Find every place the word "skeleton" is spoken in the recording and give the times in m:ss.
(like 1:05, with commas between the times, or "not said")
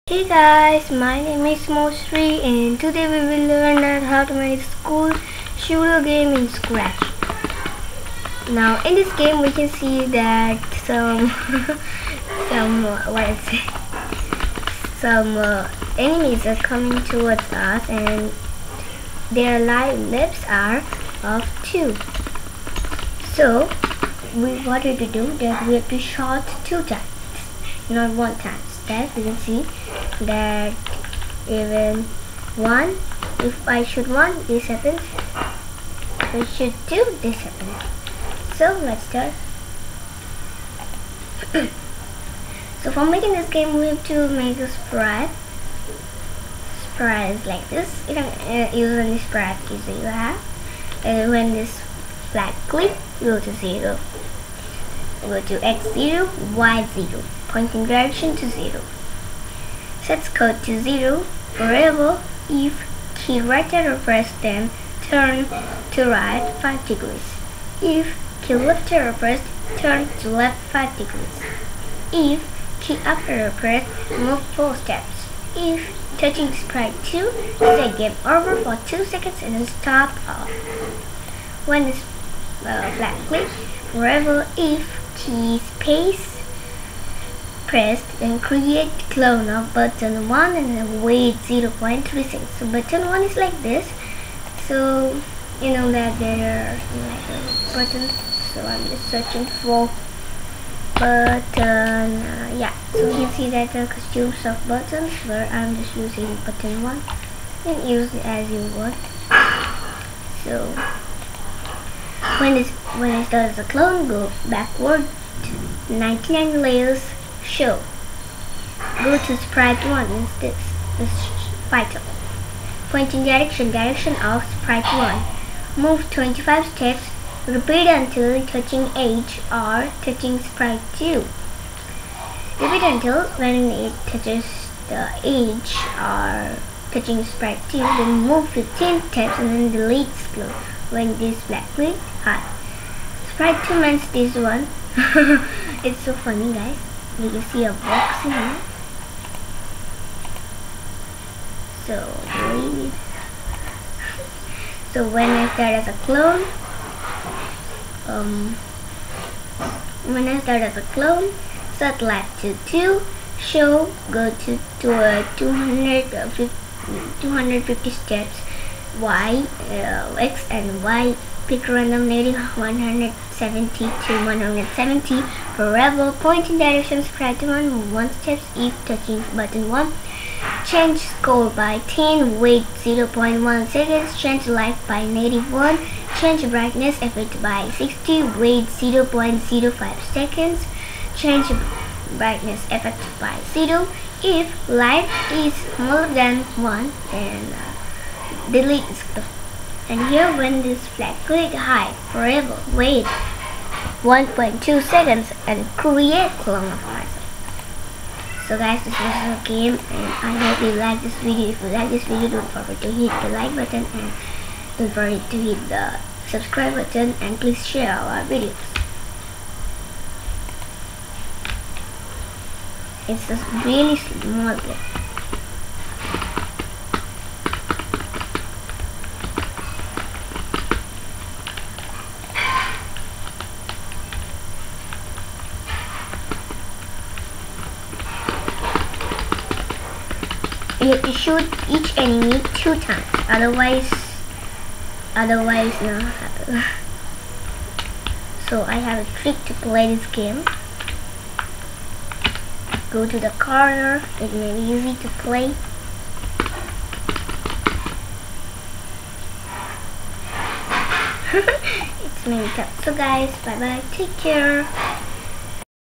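not said.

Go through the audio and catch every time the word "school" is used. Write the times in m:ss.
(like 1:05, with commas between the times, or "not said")
0:04.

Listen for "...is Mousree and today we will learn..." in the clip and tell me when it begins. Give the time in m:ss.
0:01.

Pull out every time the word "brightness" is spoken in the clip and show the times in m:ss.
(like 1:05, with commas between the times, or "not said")
3:06, 3:12.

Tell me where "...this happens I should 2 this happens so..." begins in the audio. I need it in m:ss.
0:34.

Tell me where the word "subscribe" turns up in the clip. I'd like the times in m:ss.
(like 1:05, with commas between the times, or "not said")
2:57, 3:36.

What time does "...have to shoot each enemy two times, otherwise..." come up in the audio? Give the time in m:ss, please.
4:00.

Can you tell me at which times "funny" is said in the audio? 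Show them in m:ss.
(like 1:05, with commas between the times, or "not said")
2:26.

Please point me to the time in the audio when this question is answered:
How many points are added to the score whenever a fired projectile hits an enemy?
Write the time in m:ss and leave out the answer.
3:01.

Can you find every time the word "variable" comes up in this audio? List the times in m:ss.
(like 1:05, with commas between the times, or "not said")
1:01, 1:23.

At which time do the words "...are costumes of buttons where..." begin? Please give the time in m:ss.
1:43.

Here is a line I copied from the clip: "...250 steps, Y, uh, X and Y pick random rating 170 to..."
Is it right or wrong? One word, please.
right.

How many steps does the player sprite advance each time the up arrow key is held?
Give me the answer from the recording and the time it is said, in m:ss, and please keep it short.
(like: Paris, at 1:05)
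4 steps, at 1:14.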